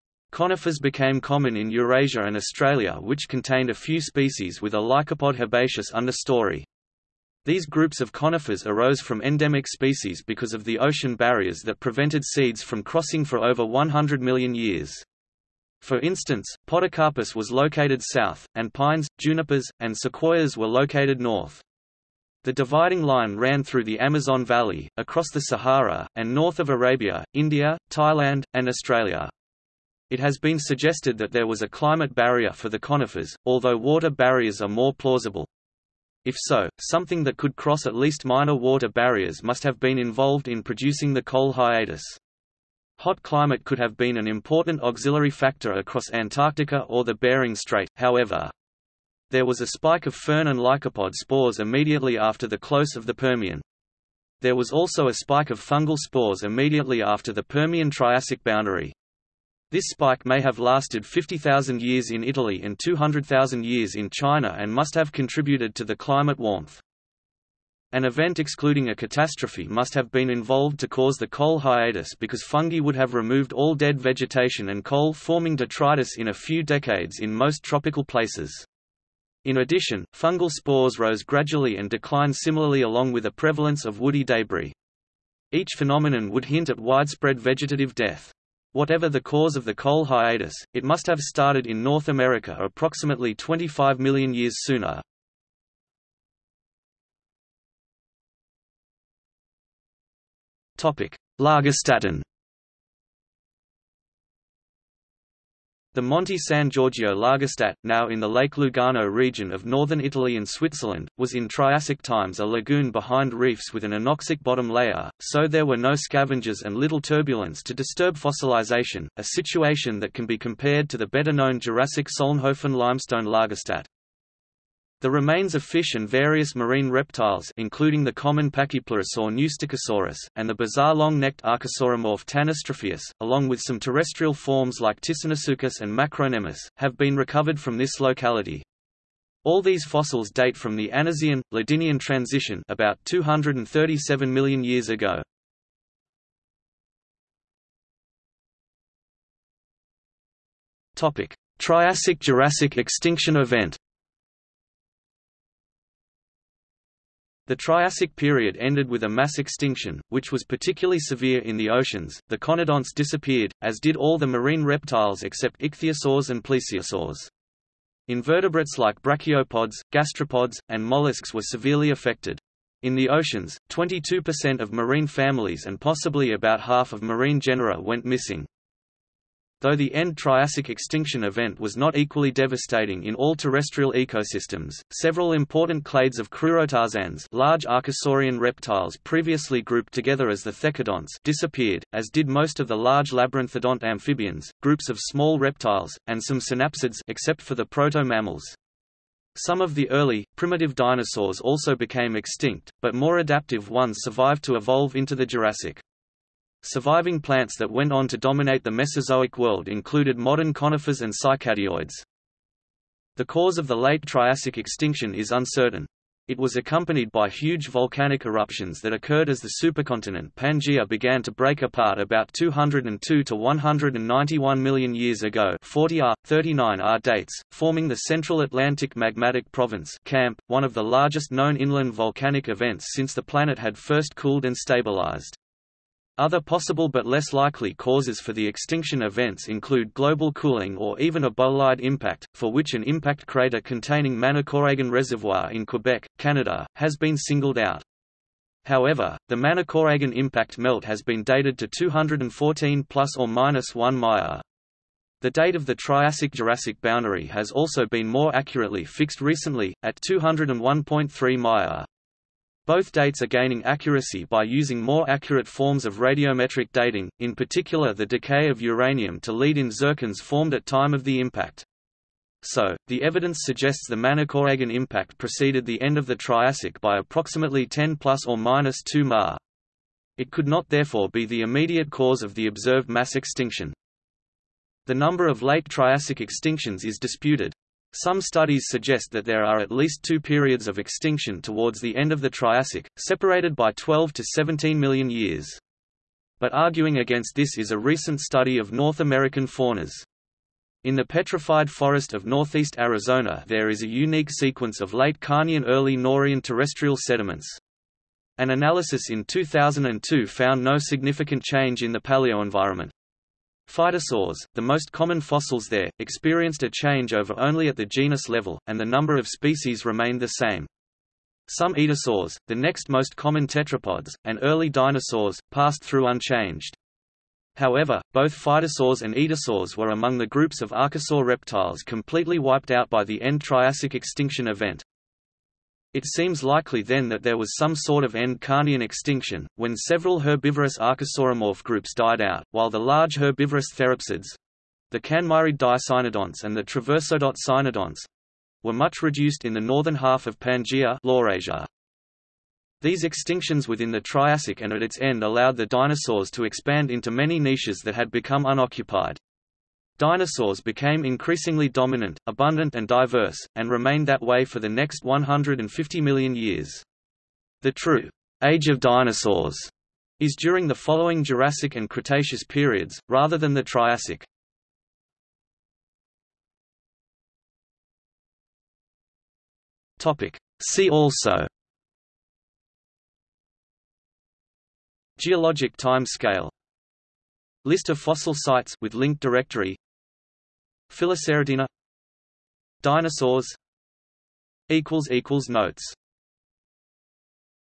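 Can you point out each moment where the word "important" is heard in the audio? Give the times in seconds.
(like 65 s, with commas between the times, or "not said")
44 s, 185 s.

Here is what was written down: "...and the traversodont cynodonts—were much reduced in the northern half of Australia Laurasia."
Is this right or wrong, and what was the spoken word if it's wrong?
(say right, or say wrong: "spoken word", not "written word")
wrong: "Pangaea", not "Australia".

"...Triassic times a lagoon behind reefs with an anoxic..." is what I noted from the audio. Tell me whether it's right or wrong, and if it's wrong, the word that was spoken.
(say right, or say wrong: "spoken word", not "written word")
right.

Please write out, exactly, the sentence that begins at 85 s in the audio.
Each phenomenon would hint at widespread vegetative death.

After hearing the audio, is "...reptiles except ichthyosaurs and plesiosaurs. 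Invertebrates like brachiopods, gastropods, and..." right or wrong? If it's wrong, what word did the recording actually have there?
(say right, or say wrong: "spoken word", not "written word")
right.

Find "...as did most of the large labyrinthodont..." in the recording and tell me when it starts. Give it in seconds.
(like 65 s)
191 s.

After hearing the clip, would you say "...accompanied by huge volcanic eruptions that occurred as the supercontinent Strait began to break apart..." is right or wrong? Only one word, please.
wrong.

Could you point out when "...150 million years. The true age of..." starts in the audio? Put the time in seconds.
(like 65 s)
365 s.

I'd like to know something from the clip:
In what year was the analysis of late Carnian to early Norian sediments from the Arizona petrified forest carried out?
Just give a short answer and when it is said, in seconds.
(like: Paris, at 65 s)
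2002, at 309 s.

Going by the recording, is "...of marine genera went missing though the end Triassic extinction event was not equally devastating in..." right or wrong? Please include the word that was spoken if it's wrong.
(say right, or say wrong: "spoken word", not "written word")
right.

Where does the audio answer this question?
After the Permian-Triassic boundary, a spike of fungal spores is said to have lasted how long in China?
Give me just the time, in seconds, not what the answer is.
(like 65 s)
62 s.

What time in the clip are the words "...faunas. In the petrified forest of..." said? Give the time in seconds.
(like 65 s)
299 s.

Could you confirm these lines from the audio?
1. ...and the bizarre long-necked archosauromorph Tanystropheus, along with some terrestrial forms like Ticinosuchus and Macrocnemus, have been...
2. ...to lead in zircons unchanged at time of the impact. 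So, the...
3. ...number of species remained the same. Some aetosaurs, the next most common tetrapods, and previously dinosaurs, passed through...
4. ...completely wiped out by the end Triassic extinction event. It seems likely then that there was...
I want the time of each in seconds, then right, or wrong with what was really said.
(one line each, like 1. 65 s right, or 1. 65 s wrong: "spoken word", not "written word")
1. 130 s right
2. 269 s wrong: "formed", not "unchanged"
3. 318 s wrong: "early", not "previously"
4. 331 s right.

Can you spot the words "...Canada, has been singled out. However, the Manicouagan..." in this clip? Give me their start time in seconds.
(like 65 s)
246 s.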